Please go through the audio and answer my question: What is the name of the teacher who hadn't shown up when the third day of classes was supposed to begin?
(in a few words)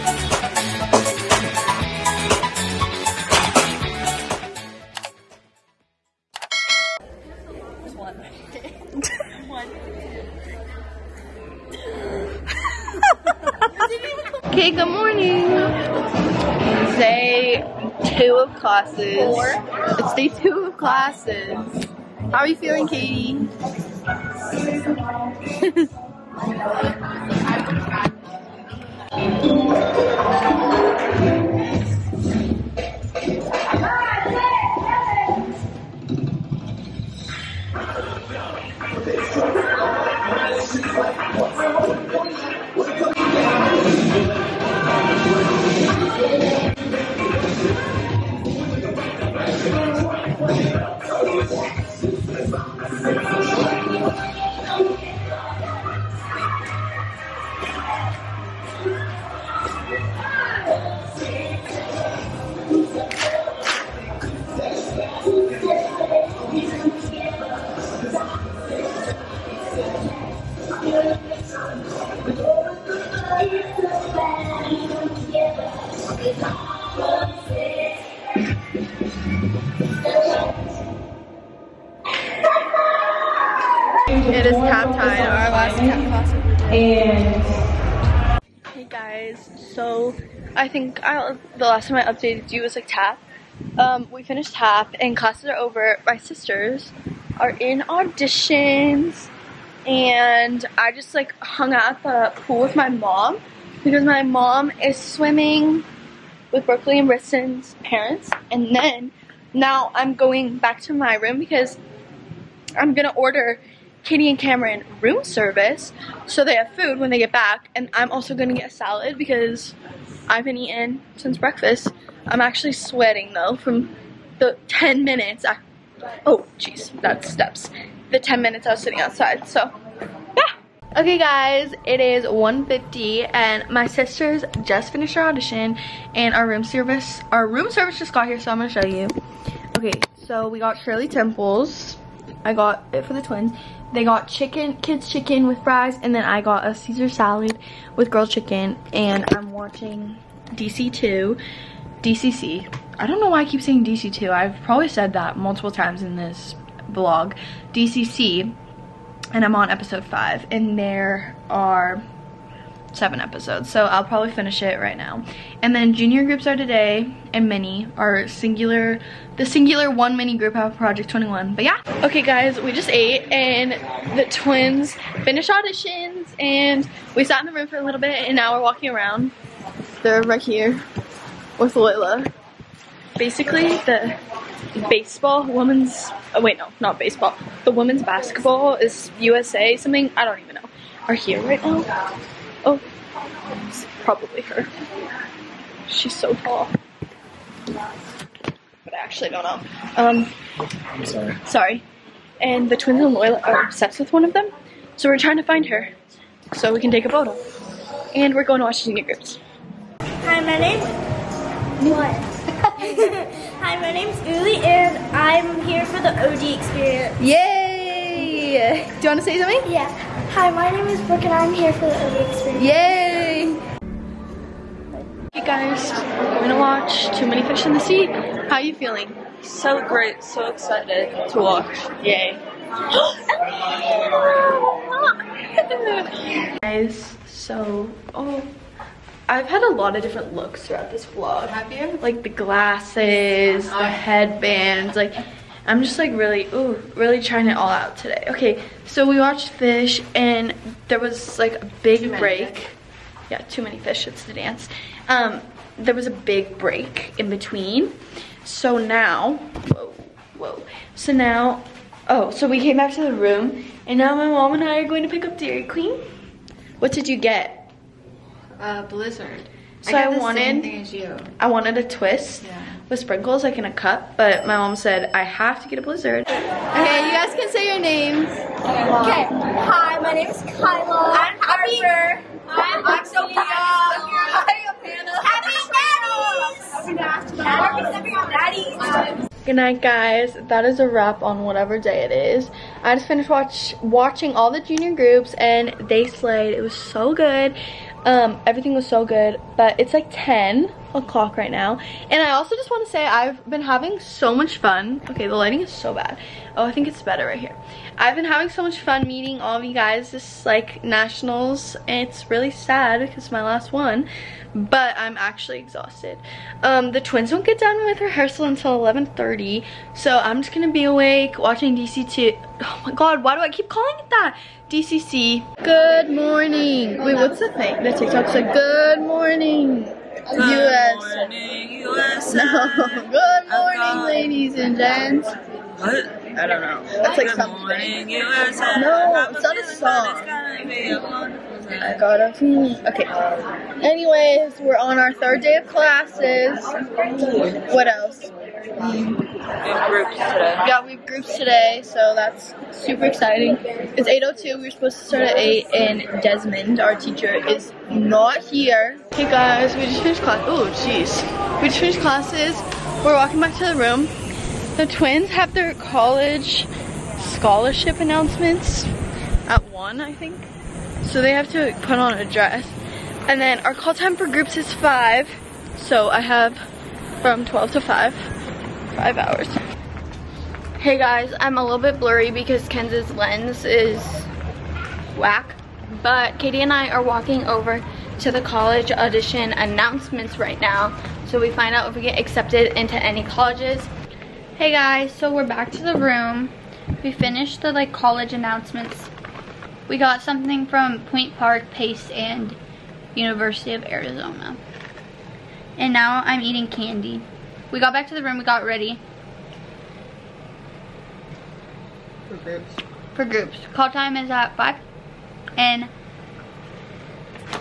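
Desmond.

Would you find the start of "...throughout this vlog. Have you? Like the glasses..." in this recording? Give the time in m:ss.
4:00.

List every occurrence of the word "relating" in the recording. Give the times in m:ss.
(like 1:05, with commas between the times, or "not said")
not said.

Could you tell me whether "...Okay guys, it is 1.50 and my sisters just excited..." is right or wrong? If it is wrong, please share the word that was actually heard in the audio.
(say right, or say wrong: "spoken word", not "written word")
wrong: "finished", not "excited".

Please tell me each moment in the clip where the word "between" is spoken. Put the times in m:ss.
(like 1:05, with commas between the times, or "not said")
4:17.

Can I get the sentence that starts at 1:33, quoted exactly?
Um, we finished tap and classes are over.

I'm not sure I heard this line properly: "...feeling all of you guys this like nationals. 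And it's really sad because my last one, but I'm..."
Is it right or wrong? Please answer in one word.
wrong.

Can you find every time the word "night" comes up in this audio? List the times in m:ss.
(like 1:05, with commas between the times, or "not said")
4:49.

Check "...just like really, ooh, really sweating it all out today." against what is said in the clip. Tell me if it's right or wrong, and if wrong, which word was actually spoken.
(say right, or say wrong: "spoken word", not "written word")
wrong: "trying", not "sweating".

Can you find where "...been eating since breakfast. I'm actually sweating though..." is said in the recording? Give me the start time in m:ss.
2:00.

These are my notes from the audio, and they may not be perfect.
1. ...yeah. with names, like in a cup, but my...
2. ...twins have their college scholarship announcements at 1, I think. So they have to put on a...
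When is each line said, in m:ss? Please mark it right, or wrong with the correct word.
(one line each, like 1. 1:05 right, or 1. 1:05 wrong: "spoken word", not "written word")
1. 4:32 wrong: "sprinkles", not "names"
2. 6:04 right.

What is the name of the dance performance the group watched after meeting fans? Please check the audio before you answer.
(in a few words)
Too Many Fish in the Sea.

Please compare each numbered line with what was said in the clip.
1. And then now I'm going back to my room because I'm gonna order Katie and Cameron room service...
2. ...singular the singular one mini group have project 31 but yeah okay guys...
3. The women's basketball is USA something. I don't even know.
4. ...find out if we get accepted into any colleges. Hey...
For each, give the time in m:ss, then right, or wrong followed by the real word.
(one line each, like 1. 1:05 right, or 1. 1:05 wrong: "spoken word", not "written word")
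1. 1:48 right
2. 2:48 wrong: "21", not "31"
3. 3:07 right
4. 6:31 right.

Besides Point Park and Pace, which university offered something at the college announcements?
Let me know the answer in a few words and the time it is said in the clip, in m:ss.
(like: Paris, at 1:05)
University of Arizona, at 6:43.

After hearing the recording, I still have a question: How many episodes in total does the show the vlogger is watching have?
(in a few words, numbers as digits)
7.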